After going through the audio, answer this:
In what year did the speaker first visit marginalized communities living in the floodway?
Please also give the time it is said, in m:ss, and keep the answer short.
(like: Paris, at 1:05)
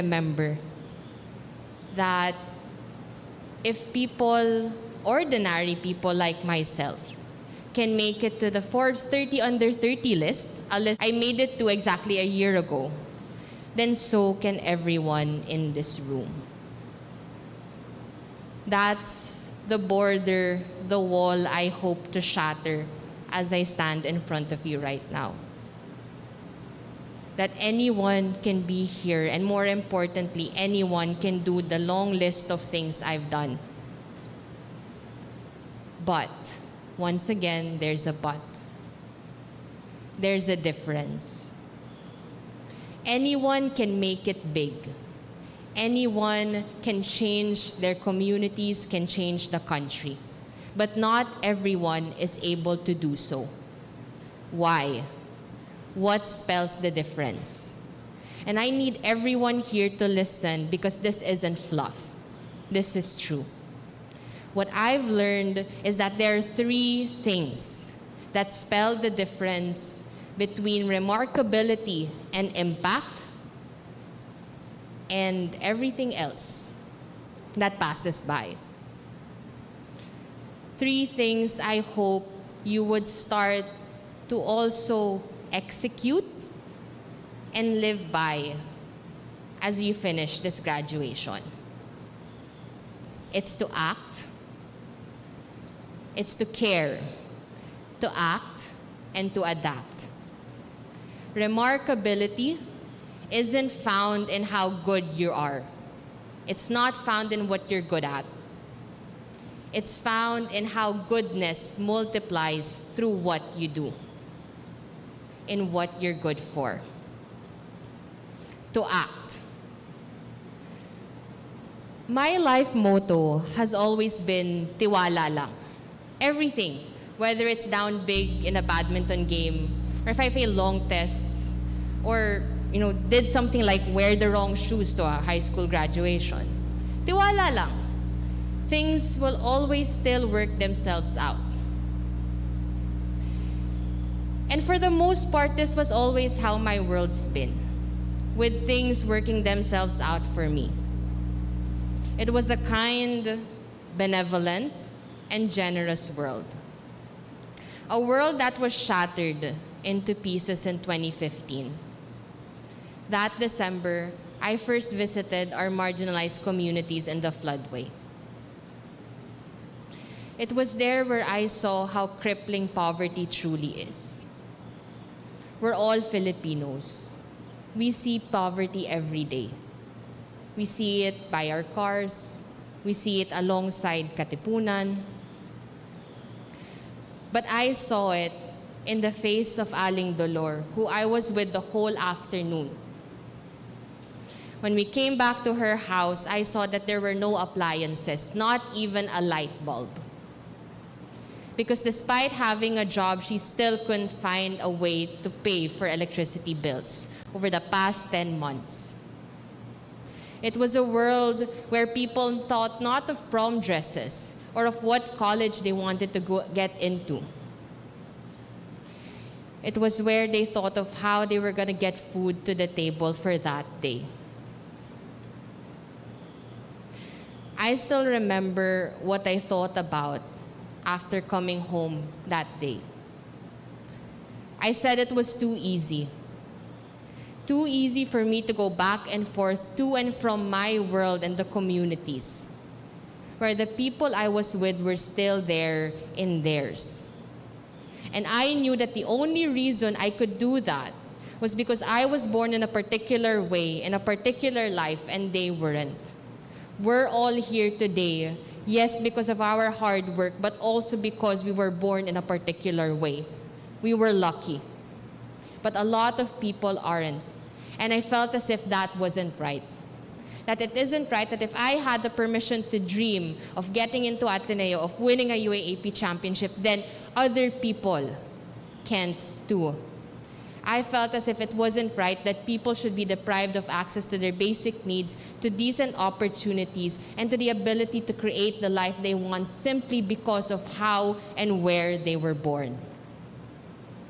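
2015, at 2:40.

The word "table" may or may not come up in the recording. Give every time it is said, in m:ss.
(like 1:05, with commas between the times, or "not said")
3:42.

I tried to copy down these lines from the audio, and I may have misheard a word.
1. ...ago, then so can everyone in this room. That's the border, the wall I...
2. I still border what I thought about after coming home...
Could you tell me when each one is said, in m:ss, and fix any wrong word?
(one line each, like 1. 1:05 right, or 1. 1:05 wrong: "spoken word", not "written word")
1. 0:12 right
2. 3:47 wrong: "remember", not "border".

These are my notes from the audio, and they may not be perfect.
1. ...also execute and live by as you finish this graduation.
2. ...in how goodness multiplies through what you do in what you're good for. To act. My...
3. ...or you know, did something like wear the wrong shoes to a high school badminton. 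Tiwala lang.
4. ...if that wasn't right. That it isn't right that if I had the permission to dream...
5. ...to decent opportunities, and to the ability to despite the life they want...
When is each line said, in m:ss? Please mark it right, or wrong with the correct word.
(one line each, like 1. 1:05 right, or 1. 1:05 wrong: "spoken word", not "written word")
1. 1:24 right
2. 1:50 right
3. 2:12 wrong: "graduation", not "badminton"
4. 4:28 right
5. 4:45 wrong: "create", not "despite".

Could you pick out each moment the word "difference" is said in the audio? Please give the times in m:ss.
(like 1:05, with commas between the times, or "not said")
0:40, 0:56, 1:09.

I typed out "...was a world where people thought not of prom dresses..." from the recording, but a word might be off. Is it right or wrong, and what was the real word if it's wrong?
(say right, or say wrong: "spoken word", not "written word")
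right.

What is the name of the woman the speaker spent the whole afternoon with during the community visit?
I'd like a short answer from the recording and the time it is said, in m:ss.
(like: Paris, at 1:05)
Aling Dolor, at 3:09.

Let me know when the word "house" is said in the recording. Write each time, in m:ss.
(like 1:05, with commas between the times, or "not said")
3:15.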